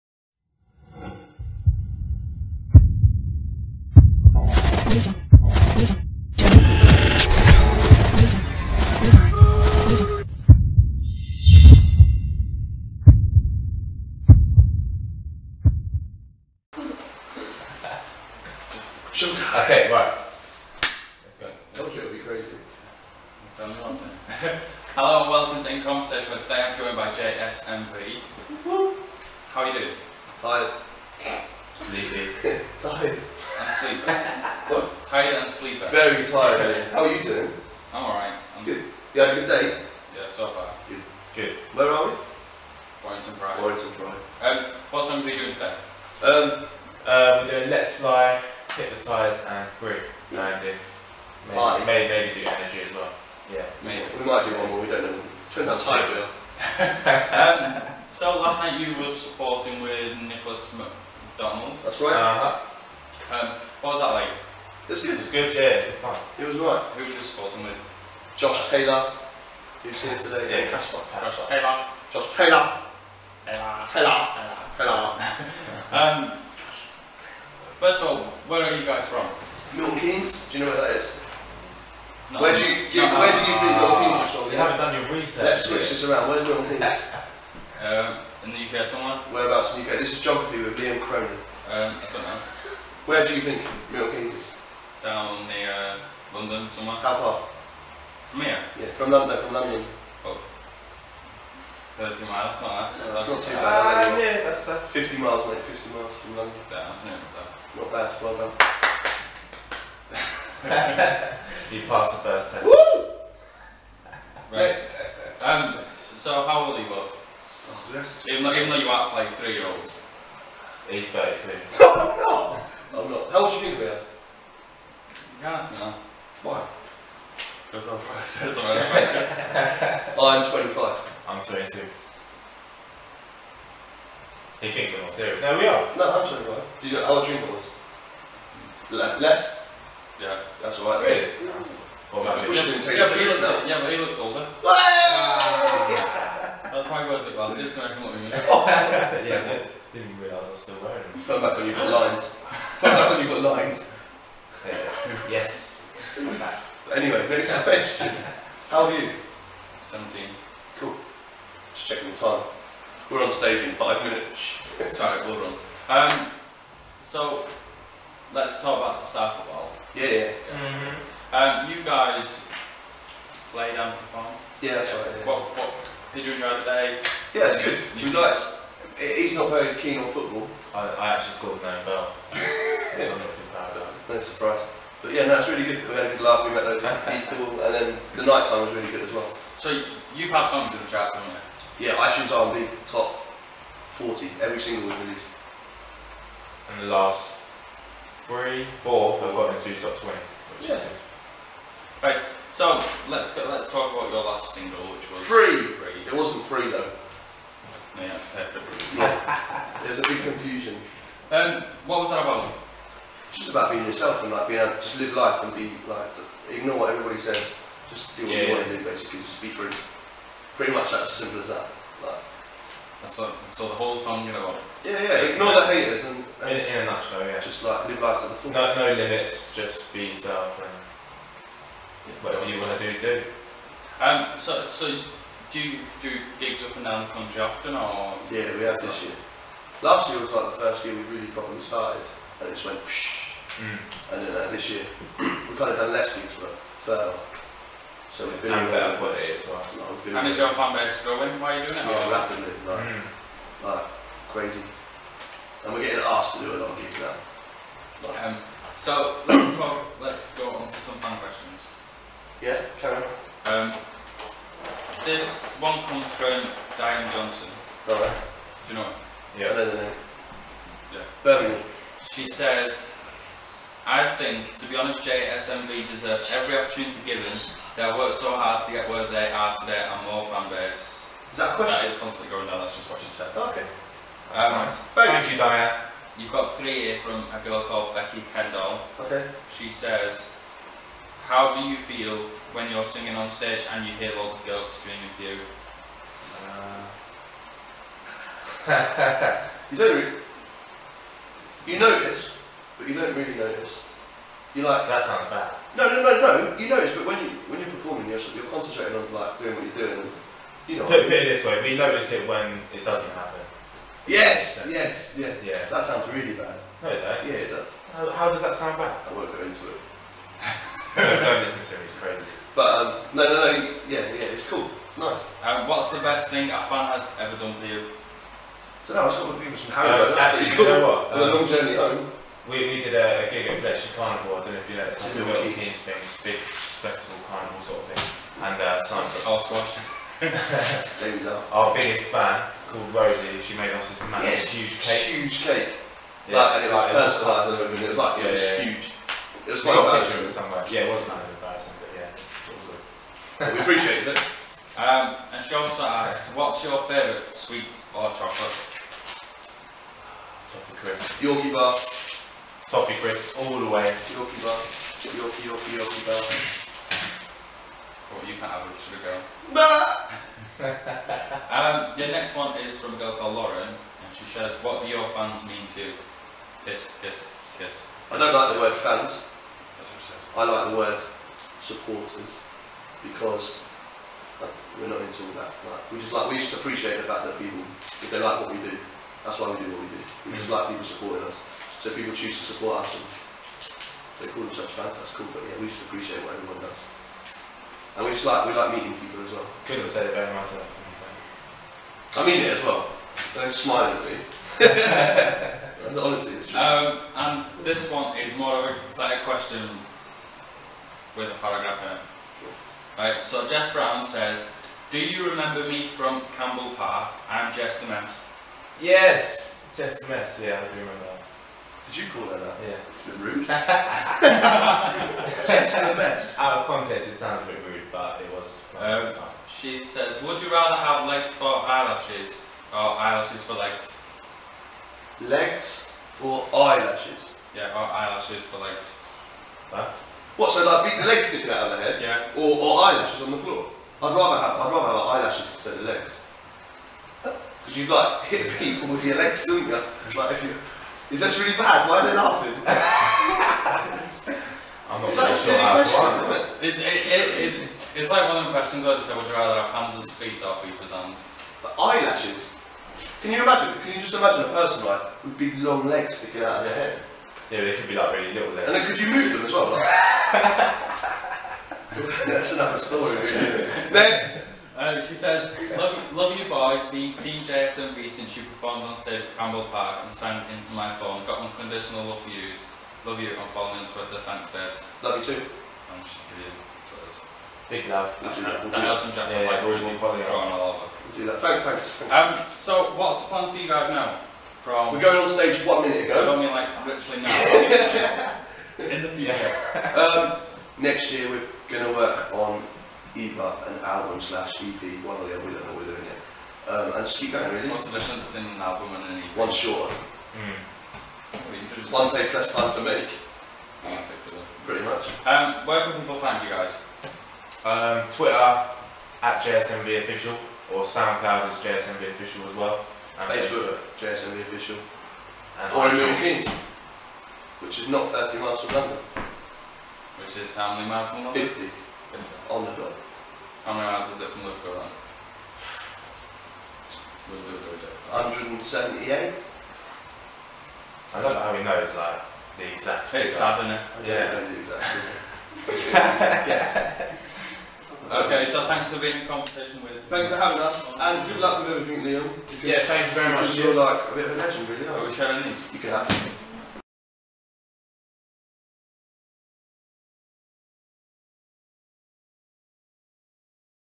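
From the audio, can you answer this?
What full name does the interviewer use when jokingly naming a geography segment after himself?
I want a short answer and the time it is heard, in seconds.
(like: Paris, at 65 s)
Liam Cronin, at 90 s.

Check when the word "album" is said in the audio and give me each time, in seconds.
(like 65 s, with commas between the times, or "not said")
503 s, 508 s.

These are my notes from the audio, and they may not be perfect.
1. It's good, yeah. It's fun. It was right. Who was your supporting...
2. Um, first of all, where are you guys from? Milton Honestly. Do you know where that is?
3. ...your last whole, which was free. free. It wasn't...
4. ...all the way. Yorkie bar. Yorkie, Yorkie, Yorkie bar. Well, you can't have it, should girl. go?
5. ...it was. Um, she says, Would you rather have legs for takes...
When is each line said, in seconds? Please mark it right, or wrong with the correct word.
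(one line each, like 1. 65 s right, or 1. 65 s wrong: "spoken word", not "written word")
1. 65 s right
2. 75 s wrong: "Keynes", not "Honestly"
3. 204 s wrong: "single", not "whole"
4. 363 s right
5. 428 s wrong: "eyelashes", not "takes".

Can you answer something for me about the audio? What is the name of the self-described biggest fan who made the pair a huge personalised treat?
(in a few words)
Rosie.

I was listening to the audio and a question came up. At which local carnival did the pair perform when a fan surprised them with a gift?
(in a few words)
Bletchley Carnival.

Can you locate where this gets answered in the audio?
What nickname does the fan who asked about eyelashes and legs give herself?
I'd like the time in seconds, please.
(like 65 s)
417 s.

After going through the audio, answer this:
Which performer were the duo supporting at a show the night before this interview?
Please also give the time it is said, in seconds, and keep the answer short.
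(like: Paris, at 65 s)
Nicholas McDonald, at 60 s.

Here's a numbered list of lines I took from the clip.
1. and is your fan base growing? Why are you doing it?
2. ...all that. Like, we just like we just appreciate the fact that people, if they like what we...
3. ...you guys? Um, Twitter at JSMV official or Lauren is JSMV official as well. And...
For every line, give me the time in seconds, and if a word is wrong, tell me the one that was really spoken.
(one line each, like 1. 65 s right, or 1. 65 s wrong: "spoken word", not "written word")
1. 249 s right
2. 385 s right
3. 516 s wrong: "SoundCloud", not "Lauren".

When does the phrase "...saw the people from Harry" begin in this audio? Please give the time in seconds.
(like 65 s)
329 s.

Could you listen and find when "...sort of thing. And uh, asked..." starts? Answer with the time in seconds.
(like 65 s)
337 s.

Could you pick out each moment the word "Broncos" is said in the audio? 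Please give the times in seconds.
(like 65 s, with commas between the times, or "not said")
not said.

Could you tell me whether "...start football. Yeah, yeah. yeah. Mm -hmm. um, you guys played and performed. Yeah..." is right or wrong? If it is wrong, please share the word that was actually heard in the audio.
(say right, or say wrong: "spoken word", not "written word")
right.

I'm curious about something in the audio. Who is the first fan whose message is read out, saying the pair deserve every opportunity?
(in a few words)
Diane Johnson.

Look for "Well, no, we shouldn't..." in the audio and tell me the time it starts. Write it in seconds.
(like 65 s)
142 s.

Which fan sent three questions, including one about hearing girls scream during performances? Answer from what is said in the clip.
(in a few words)
Becky Kendall.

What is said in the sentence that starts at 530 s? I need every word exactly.
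Which is how many miles from London?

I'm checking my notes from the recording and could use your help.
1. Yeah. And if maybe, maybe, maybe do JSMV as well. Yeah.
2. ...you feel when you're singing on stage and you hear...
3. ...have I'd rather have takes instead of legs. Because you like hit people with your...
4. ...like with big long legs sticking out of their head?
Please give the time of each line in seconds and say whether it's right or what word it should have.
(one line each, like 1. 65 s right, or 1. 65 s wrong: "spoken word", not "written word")
1. 50 s wrong: "Energy", not "JSMV"
2. 291 s right
3. 444 s wrong: "eyelashes", not "takes"
4. 464 s right.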